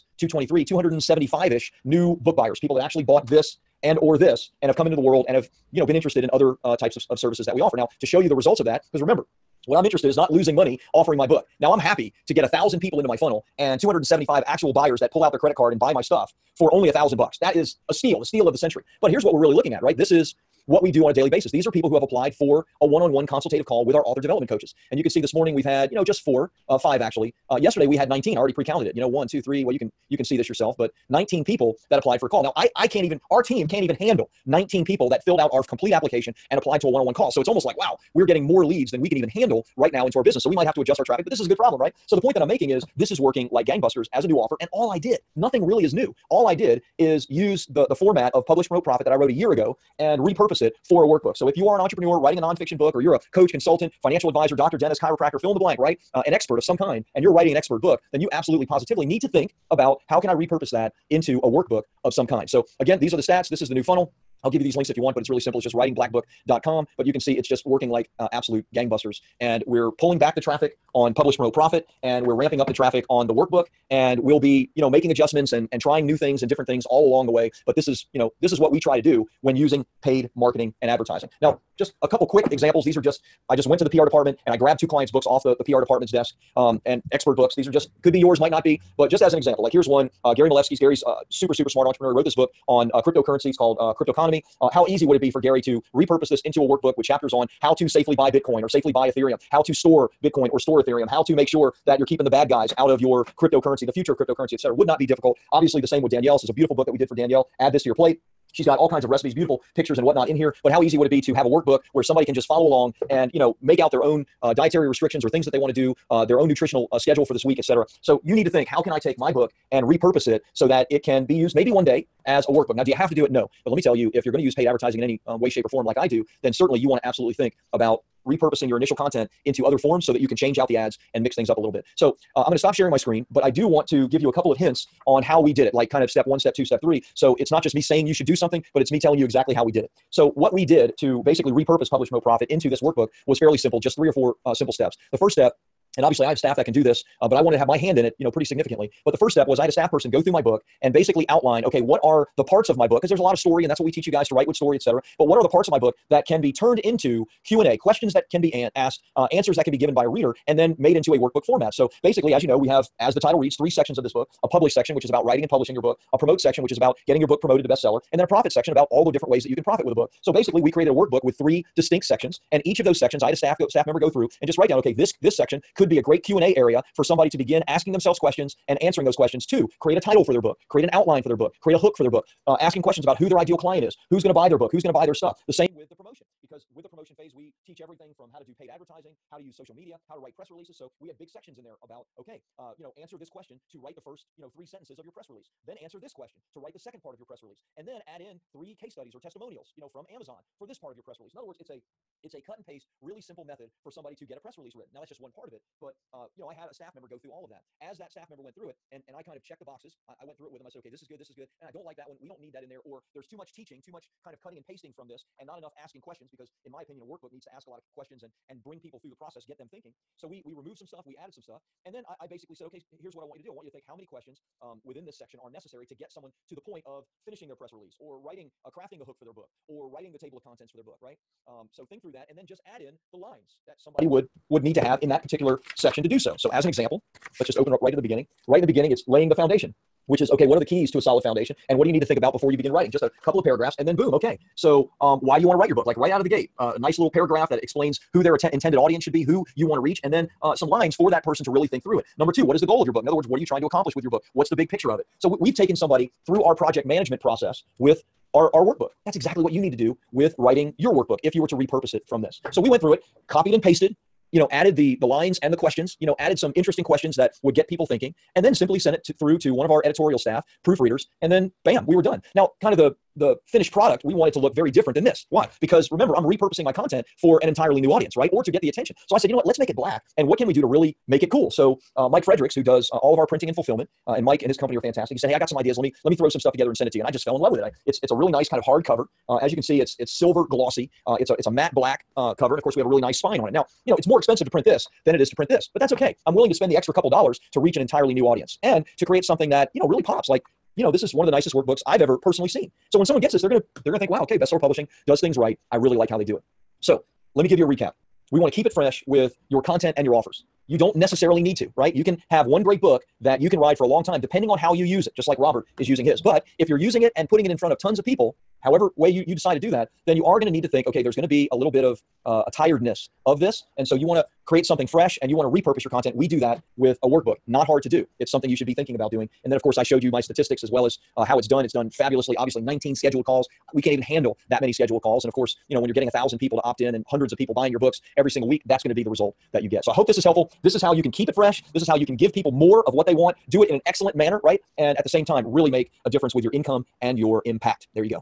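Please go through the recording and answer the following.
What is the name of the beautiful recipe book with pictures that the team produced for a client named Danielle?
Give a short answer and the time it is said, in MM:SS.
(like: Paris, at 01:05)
Add this to your plate, at 01:47.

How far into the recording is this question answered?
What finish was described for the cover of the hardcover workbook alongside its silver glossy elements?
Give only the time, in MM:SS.
04:51.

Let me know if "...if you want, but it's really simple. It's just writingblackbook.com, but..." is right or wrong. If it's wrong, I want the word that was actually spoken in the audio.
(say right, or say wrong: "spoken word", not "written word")
right.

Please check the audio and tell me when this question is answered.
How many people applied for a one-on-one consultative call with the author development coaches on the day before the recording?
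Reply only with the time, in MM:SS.
00:27.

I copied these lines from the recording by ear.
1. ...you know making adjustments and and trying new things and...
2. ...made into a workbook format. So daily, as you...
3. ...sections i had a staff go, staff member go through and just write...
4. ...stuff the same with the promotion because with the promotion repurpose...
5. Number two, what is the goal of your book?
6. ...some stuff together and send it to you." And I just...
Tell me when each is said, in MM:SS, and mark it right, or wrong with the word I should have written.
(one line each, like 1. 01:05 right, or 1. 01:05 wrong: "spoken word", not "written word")
1. 01:14 right
2. 02:40 wrong: "basically", not "daily"
3. 02:52 right
4. 03:05 wrong: "phase", not "repurpose"
5. 04:12 right
6. 04:46 right.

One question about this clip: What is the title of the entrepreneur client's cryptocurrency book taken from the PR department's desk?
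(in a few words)
Cryptoconomy.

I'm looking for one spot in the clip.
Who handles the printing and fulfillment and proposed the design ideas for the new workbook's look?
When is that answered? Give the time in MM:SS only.
04:42.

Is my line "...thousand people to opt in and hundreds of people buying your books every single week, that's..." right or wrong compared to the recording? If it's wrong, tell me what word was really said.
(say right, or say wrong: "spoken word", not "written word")
right.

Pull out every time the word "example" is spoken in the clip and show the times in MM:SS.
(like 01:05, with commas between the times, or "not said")
01:22, 01:29, 03:56.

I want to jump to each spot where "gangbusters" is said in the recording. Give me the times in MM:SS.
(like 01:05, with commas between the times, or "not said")
00:43, 01:08.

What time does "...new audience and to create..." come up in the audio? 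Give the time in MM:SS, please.
04:58.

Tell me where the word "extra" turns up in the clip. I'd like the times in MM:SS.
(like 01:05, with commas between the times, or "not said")
04:56.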